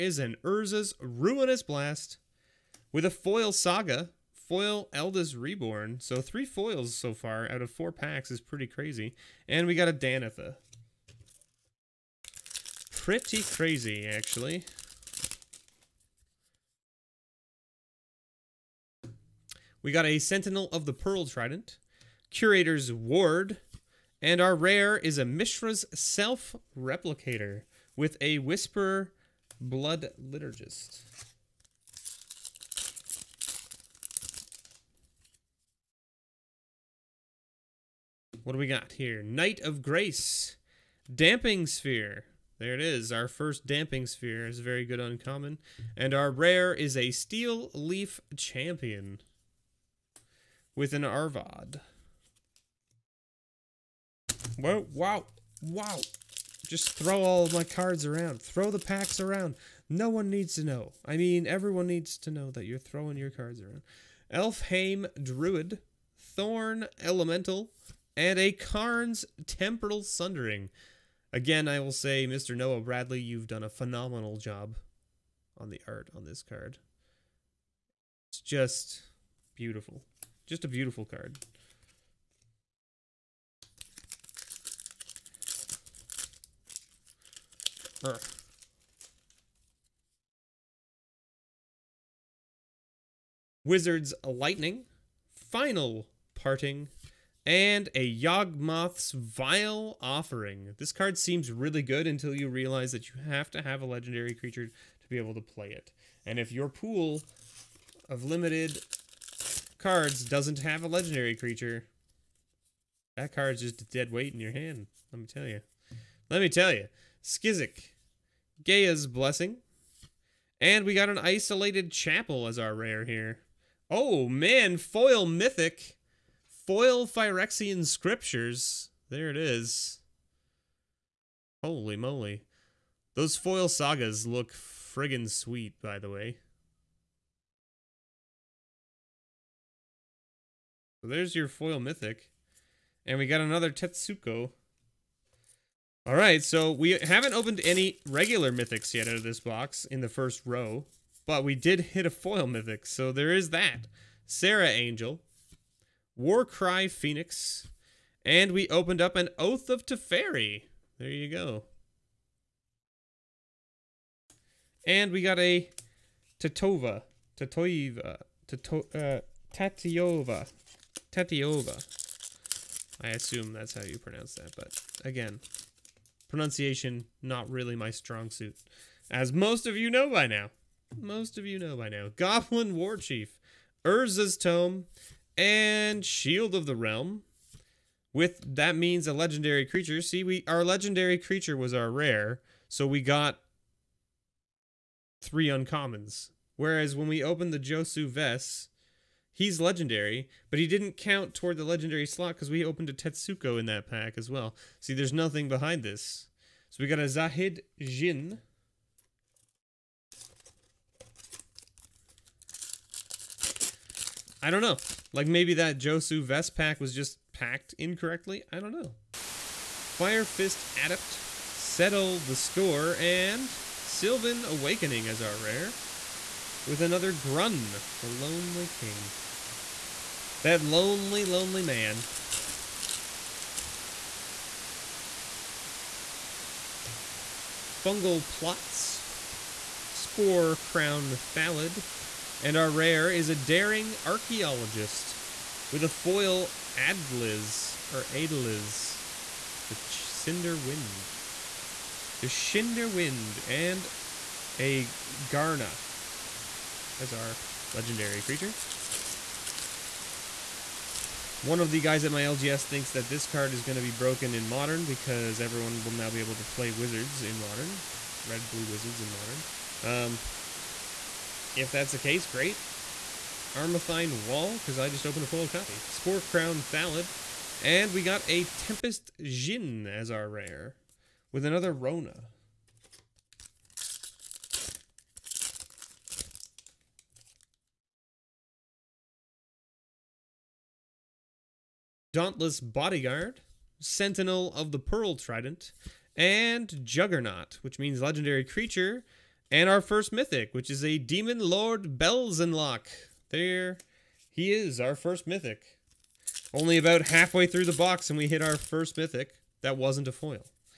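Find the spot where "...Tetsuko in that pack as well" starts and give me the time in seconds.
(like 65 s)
202 s.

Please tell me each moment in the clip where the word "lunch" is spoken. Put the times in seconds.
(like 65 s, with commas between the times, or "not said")
not said.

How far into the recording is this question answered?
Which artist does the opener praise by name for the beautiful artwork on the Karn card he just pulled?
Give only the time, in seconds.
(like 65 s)
72 s.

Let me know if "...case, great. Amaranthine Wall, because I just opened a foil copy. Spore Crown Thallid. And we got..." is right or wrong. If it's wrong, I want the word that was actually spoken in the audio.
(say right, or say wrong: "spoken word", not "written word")
right.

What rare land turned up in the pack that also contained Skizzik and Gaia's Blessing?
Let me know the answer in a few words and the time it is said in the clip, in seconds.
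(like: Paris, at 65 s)
Isolated Chapel, at 121 s.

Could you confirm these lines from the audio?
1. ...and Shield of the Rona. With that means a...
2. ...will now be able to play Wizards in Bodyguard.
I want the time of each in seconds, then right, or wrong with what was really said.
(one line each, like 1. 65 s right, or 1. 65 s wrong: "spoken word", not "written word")
1. 185 s wrong: "Realm", not "Rona"
2. 265 s wrong: "Modern", not "Bodyguard".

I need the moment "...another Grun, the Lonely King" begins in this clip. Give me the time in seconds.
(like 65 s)
226 s.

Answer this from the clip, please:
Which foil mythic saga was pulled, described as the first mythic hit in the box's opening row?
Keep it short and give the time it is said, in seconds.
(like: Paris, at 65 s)
Phyrexian Scriptures, at 127 s.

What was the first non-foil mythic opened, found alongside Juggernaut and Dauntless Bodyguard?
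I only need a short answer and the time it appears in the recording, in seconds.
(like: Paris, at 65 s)
Demon Lord Belzenlok, at 300 s.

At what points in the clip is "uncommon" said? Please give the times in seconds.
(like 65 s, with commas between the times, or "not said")
44 s, 195 s.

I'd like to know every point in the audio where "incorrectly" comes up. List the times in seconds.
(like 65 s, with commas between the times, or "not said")
217 s.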